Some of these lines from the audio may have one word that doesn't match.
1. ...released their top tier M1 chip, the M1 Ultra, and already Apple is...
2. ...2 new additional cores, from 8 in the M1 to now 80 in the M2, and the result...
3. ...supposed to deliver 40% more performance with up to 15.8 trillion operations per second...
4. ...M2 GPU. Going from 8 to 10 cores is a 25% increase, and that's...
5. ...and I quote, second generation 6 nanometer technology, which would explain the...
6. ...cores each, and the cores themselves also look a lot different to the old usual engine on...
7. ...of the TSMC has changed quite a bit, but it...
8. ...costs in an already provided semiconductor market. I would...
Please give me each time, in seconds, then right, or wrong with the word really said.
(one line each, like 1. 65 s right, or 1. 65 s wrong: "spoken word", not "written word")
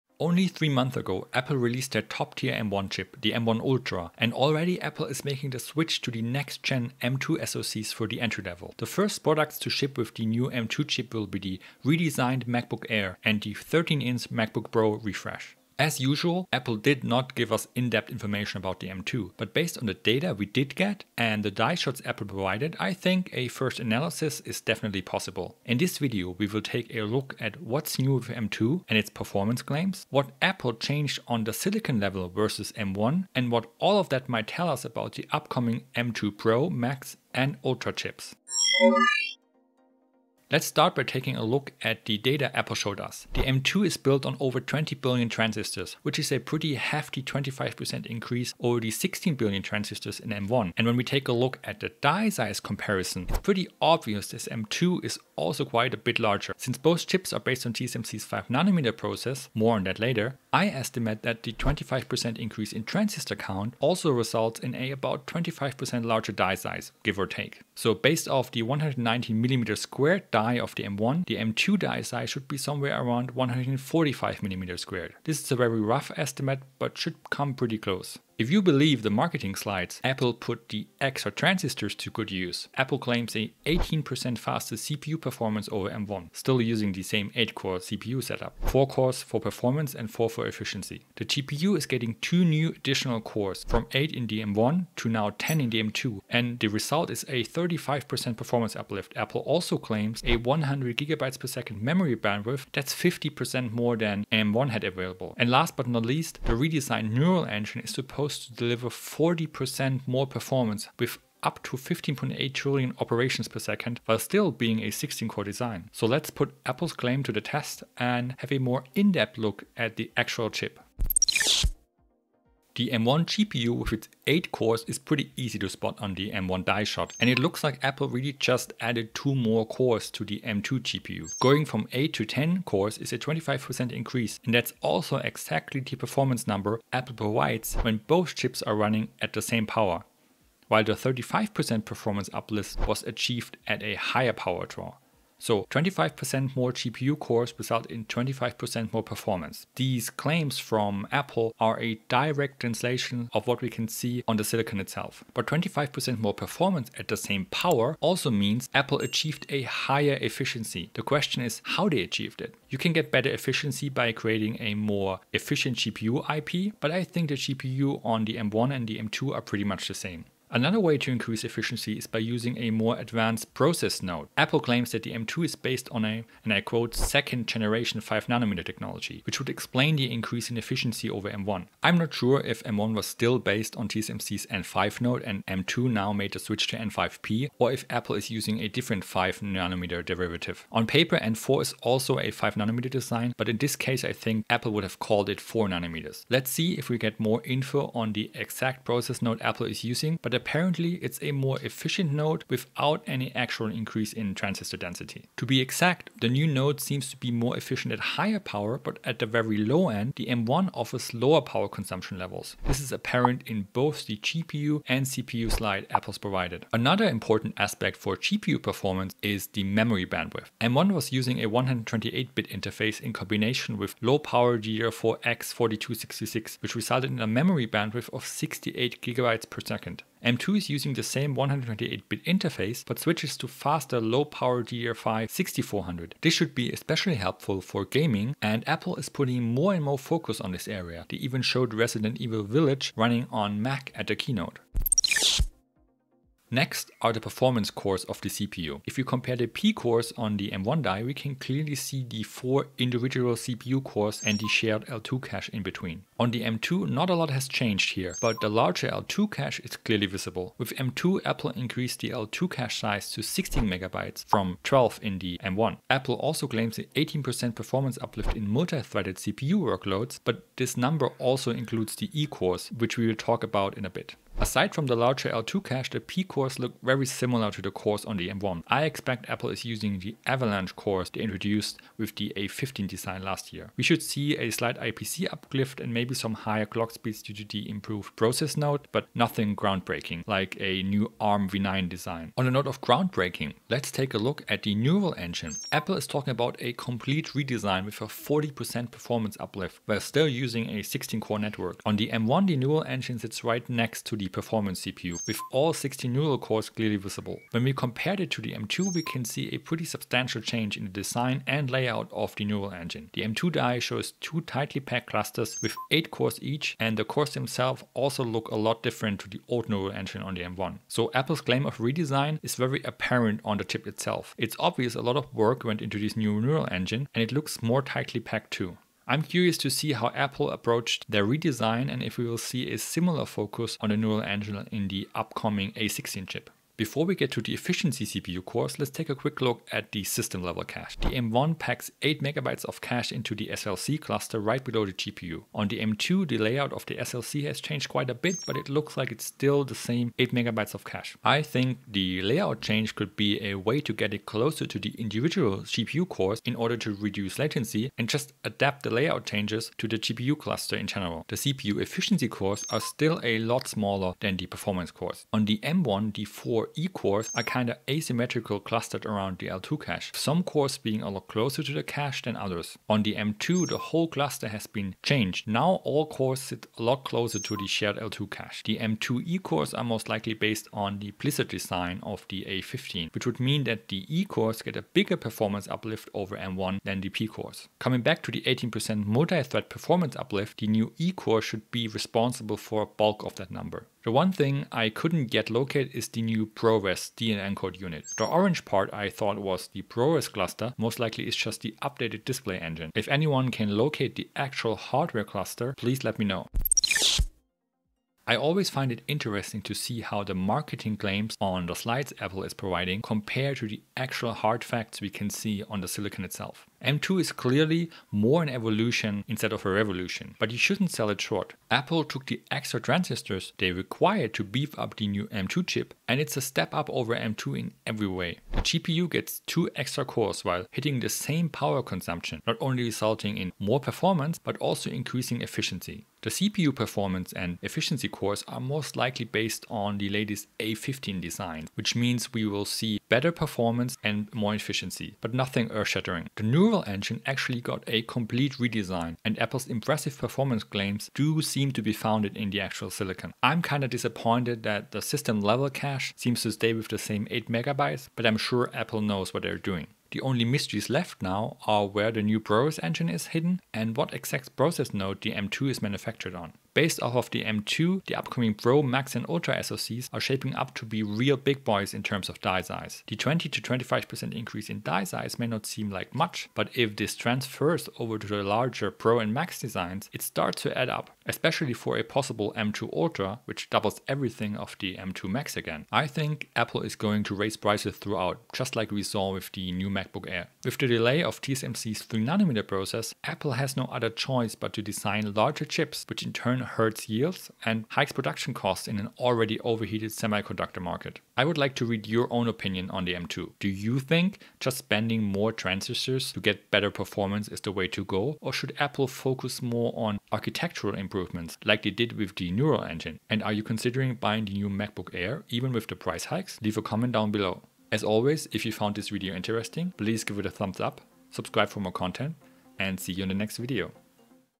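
1. 1 s right
2. 92 s wrong: "10", not "80"
3. 107 s right
4. 130 s right
5. 176 s wrong: "5", not "6"
6. 316 s wrong: "neural", not "usual"
7. 346 s wrong: "SLC", not "TSMC"
8. 498 s wrong: "overheated", not "provided".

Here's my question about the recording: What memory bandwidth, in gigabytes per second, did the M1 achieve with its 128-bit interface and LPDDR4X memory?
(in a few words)
68 GB/s.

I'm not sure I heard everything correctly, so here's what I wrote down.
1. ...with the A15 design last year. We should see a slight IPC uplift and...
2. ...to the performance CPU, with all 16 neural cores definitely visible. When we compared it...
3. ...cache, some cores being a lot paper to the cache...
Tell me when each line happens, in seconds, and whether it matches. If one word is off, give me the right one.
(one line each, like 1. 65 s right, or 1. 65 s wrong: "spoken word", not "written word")
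1. 281 s right
2. 304 s wrong: "clearly", not "definitely"
3. 369 s wrong: "closer", not "paper".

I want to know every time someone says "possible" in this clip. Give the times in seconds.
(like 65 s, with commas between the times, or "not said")
25 s, 482 s.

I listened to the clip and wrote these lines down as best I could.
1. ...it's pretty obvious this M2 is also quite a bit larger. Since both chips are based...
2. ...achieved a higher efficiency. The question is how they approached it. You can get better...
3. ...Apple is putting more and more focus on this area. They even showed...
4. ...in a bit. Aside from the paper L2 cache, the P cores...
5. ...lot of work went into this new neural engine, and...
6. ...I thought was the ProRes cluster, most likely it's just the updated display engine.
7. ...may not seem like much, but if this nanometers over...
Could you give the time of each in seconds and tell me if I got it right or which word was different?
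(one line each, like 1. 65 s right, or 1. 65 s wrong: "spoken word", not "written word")
1. 53 s right
2. 158 s wrong: "achieved", not "approached"
3. 238 s right
4. 273 s wrong: "larger", not "paper"
5. 325 s right
6. 398 s right
7. 475 s wrong: "transfers", not "nanometers".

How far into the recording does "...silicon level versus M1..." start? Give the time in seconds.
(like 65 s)
31 s.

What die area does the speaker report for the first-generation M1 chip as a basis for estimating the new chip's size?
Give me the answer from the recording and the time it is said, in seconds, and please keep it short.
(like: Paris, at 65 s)
190 mm², at 68 s.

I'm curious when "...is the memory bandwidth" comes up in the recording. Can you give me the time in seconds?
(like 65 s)
219 s.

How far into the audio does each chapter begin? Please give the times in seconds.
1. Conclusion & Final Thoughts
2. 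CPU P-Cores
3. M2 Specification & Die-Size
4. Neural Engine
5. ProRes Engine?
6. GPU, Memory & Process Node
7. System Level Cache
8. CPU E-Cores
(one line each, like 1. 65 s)
1. 407 s
2. 245 s
3. 40 s
4. 292 s
5. 393 s
6. 121 s
7. 336 s
8. 360 s.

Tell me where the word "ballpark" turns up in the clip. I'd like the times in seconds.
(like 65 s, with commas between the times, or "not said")
not said.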